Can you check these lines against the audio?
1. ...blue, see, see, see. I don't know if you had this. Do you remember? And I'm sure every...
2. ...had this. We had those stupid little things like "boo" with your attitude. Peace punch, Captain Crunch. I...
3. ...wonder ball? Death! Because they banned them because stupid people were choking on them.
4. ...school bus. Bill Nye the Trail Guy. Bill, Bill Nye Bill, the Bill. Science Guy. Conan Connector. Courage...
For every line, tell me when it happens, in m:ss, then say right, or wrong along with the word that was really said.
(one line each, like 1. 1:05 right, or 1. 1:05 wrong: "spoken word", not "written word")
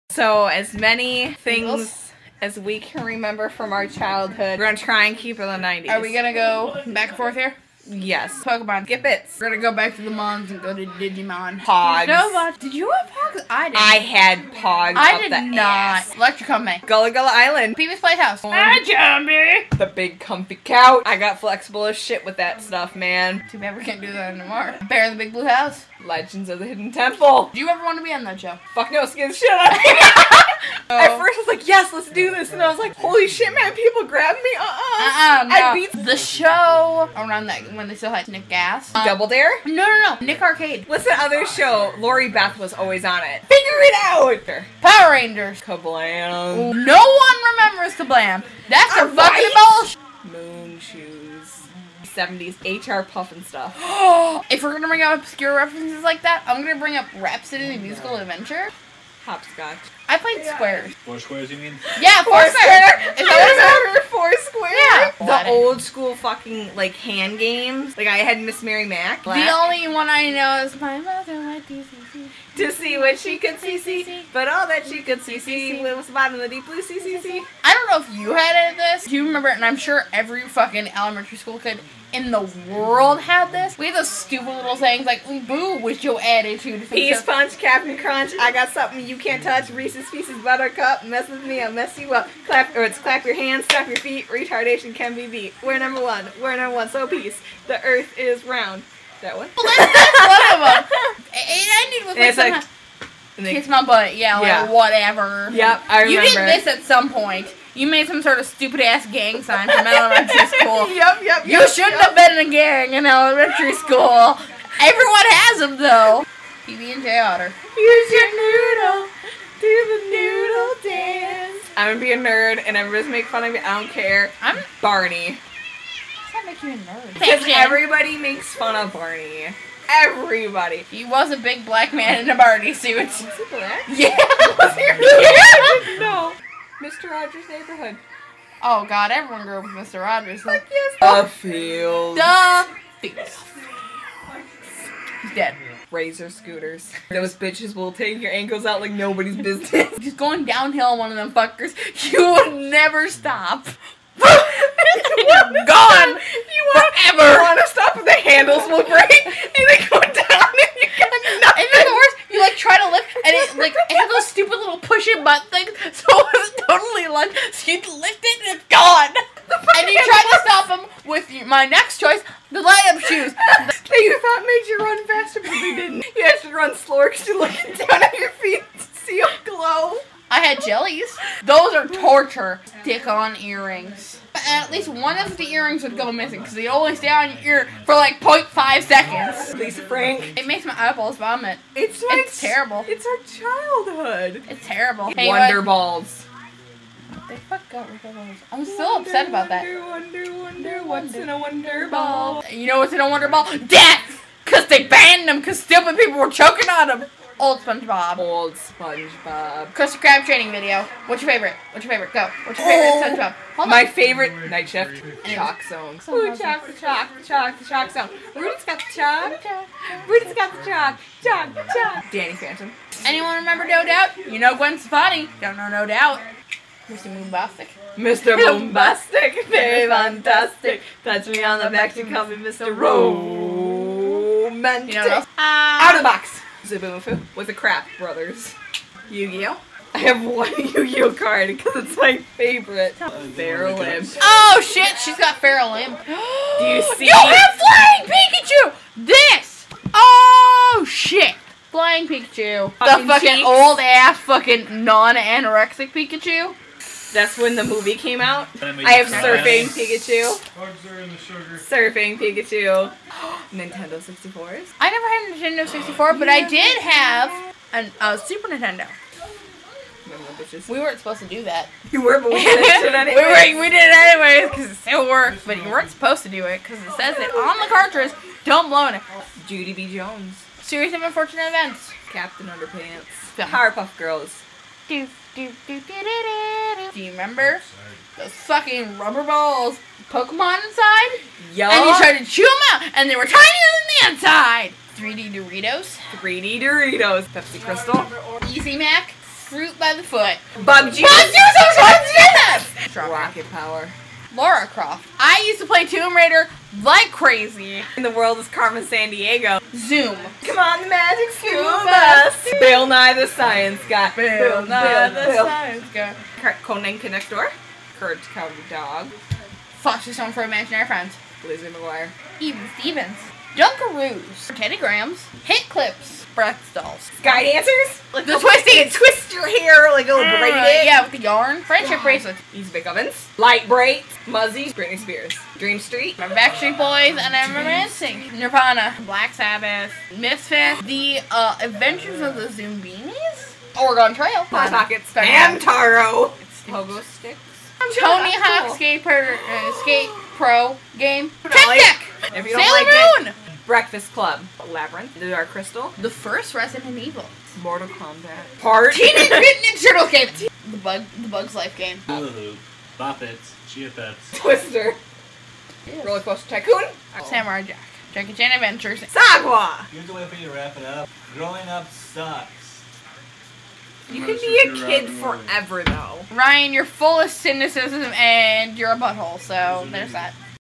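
1. 1:16 right
2. 1:23 right
3. 3:23 right
4. 5:11 wrong: "Science", not "Trail".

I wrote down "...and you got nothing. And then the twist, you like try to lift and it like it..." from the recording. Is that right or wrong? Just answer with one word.
wrong.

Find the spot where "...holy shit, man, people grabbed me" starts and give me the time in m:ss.
0:32.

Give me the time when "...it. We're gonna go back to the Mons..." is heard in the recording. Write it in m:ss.
0:09.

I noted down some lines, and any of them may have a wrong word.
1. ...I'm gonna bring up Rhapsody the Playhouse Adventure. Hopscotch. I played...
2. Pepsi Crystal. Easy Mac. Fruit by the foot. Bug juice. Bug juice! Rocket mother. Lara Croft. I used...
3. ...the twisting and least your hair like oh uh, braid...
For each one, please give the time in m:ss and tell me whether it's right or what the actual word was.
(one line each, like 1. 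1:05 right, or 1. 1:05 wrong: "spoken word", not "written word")
1. 0:56 wrong: "Musical", not "Playhouse"
2. 4:57 wrong: "power", not "mother"
3. 5:28 wrong: "twist", not "least".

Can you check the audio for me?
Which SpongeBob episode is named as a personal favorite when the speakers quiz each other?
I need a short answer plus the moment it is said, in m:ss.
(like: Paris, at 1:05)
Night Shift, at 3:34.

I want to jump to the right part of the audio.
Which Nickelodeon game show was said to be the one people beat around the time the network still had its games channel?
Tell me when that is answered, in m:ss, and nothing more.
0:40.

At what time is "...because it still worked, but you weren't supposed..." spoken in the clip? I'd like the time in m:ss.
4:34.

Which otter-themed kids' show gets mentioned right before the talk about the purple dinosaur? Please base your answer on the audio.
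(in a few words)
PB and J Otter.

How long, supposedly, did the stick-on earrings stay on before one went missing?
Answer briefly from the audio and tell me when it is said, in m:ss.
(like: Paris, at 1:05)
0.5 seconds, at 3:08.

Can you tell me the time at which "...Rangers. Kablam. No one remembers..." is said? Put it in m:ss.
0:45.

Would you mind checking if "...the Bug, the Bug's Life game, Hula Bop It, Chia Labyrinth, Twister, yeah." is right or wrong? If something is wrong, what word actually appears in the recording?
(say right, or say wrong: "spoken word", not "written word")
wrong: "Pets", not "Labyrinth".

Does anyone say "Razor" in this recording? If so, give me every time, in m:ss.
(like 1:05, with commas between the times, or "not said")
2:25.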